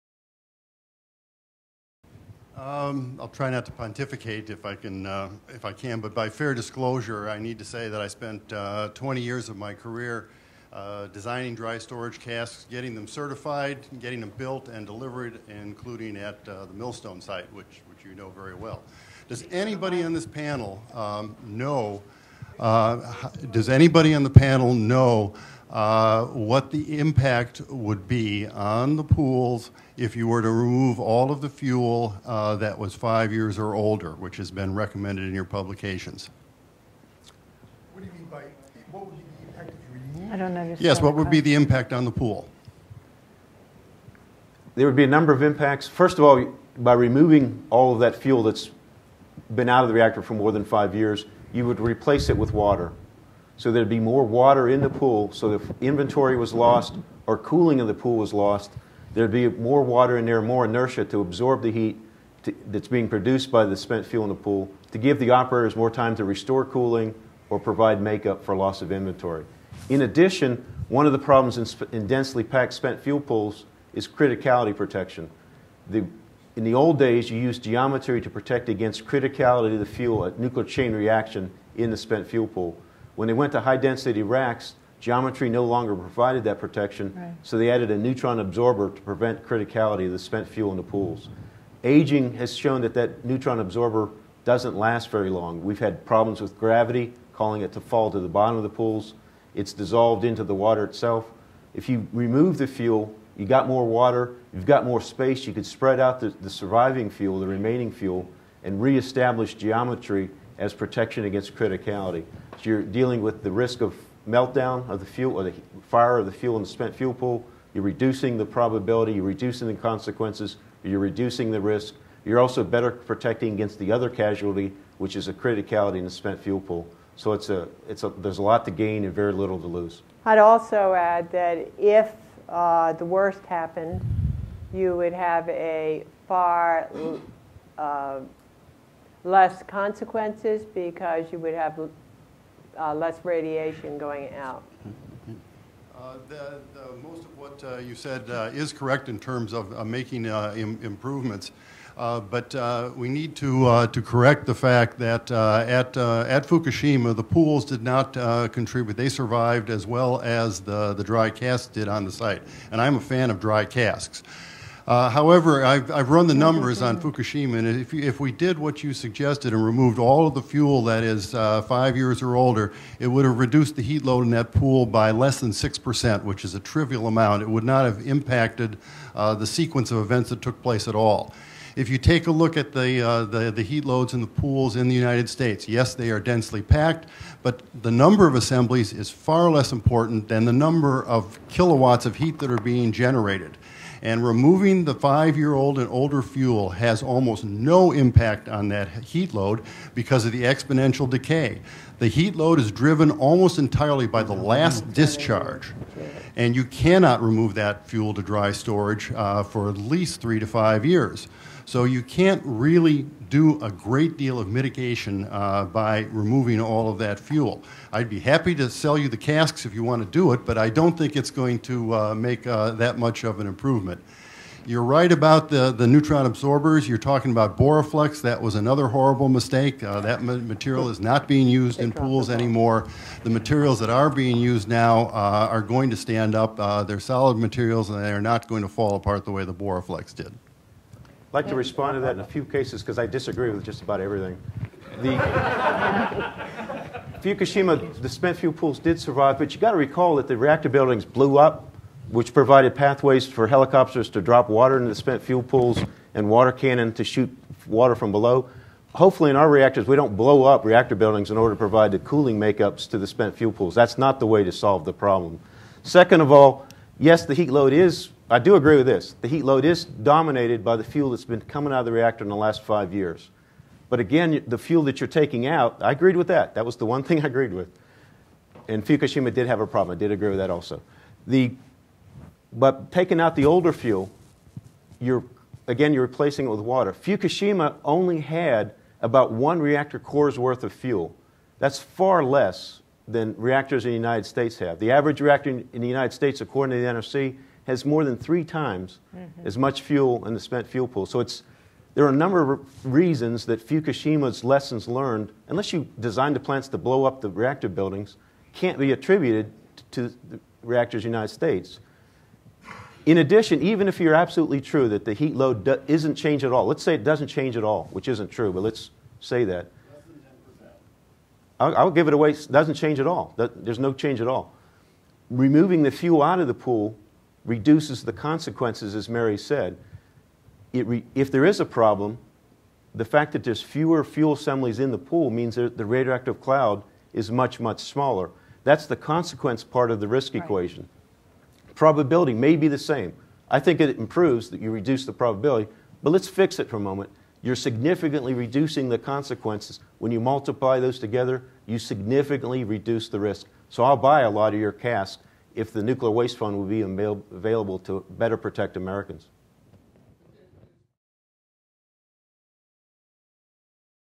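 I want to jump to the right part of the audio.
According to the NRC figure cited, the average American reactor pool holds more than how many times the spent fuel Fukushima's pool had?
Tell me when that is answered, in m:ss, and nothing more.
4:58.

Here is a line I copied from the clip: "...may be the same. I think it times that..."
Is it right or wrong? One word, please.
wrong.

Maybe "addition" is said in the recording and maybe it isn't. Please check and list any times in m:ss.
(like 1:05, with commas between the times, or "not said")
1:10, 5:13.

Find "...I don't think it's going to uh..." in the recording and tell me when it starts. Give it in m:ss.
3:40.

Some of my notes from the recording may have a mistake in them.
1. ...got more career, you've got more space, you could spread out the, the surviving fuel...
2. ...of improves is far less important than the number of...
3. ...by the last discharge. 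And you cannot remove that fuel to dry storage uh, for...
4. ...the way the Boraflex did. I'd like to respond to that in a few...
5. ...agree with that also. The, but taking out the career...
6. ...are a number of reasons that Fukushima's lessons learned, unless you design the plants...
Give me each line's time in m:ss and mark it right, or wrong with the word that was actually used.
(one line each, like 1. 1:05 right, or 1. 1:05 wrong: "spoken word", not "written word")
1. 1:43 wrong: "water", not "career"
2. 3:08 wrong: "assemblies", not "improves"
3. 3:24 right
4. 3:59 right
5. 4:40 wrong: "older", not "career"
6. 5:02 right.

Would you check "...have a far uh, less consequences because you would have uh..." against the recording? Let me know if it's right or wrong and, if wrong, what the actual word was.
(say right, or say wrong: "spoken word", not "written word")
right.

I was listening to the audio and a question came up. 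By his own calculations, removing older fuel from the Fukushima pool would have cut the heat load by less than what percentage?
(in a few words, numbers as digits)
6%.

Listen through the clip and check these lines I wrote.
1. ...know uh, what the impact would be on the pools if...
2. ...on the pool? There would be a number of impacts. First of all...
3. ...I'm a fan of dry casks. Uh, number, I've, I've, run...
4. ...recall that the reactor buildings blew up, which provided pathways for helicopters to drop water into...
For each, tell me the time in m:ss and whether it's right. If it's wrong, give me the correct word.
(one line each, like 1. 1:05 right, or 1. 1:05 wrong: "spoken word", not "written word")
1. 0:24 right
2. 0:41 right
3. 2:42 wrong: "however", not "number"
4. 4:09 right.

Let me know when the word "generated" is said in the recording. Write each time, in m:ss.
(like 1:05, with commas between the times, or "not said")
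3:12.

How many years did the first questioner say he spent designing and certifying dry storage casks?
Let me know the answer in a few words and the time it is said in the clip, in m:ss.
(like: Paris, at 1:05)
20 years, at 0:08.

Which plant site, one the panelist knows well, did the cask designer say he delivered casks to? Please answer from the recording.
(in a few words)
Millstone.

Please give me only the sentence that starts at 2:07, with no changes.
So it's a, it's a, there's a lot to gain and very little to lose.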